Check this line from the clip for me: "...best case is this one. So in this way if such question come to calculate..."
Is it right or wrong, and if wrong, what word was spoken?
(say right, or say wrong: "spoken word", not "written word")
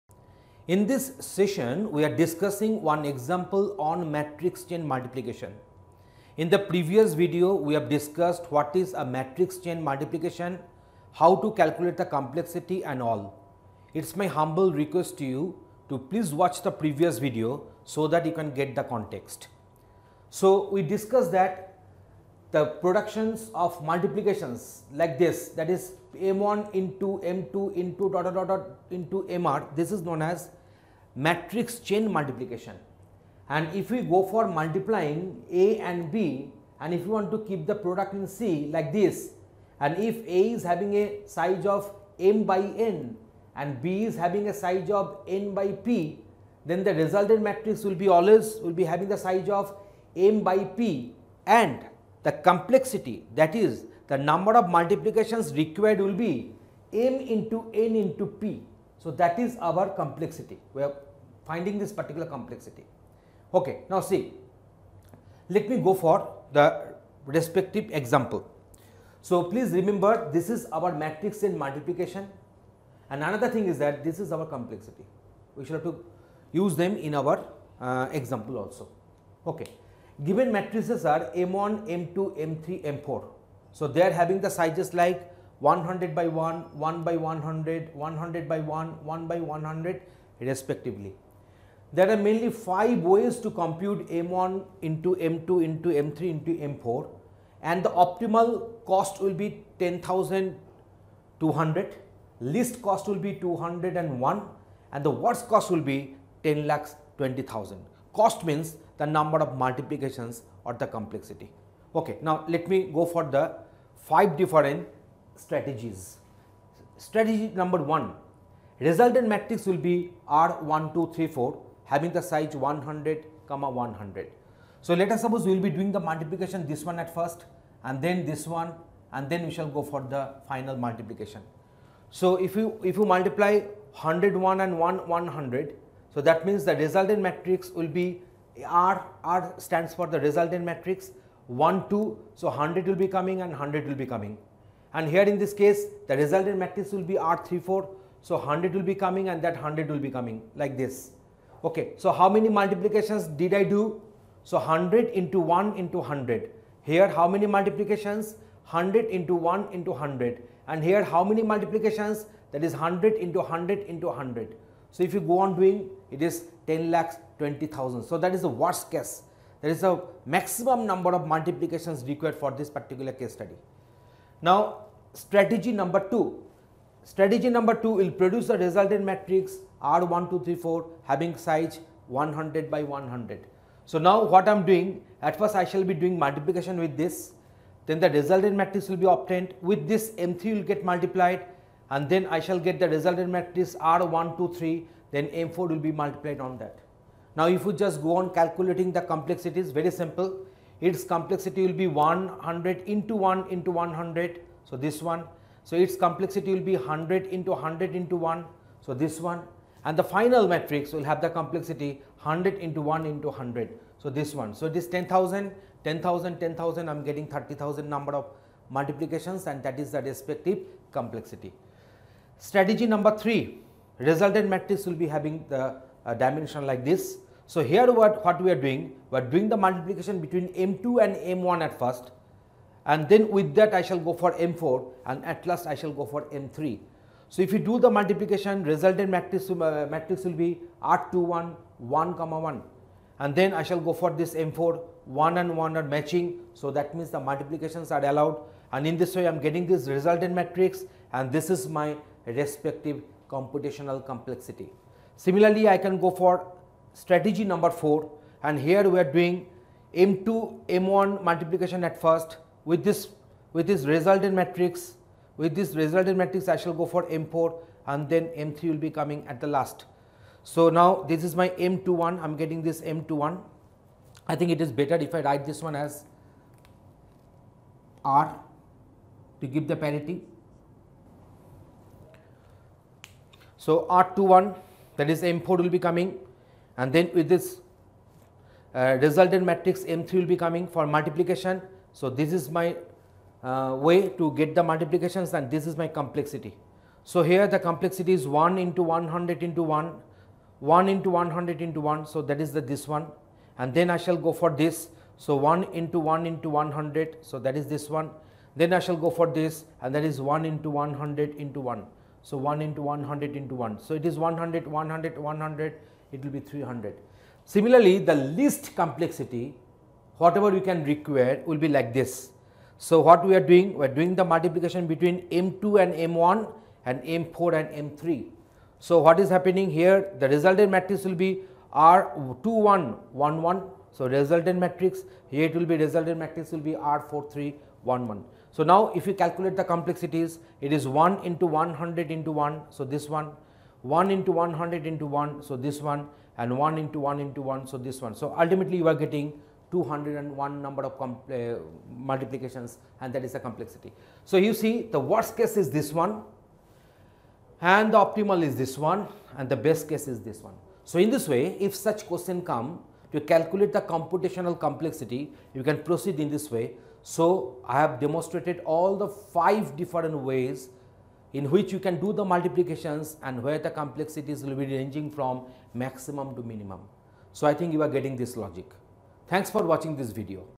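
right.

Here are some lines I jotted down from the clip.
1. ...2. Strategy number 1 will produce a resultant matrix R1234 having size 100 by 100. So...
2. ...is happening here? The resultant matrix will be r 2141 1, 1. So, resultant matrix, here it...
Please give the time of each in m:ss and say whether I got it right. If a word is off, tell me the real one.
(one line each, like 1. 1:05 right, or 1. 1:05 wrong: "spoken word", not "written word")
1. 2:56 wrong: "2", not "1"
2. 5:29 wrong: "2111", not "2141".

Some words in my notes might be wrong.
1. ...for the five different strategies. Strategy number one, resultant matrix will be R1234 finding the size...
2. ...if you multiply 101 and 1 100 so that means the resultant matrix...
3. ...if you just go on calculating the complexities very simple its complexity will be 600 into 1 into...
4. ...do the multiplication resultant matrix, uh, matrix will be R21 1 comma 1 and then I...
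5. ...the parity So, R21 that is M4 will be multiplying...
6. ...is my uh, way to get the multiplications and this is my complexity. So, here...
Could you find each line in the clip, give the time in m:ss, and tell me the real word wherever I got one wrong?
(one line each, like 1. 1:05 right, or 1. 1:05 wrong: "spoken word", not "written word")
1. 1:53 wrong: "having", not "finding"
2. 2:12 right
3. 3:17 wrong: "100", not "600"
4. 3:57 right
5. 4:39 wrong: "coming", not "multiplying"
6. 4:52 right.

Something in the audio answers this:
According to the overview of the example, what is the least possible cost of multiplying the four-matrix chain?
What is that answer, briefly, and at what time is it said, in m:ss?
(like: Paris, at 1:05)
201, at 1:42.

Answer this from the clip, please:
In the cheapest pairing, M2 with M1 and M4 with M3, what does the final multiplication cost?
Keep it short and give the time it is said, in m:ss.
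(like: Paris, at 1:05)
1 into 1 into 1, at 5:46.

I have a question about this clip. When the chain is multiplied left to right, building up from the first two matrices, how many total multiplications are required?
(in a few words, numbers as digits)
30000.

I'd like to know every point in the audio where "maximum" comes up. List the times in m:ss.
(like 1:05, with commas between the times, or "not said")
2:50, 6:15.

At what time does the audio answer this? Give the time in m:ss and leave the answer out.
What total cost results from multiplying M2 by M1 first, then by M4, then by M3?
5:16.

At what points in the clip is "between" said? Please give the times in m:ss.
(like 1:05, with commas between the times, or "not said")
3:50, 5:24.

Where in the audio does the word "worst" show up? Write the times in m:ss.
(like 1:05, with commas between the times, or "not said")
1:45, 2:48, 5:54.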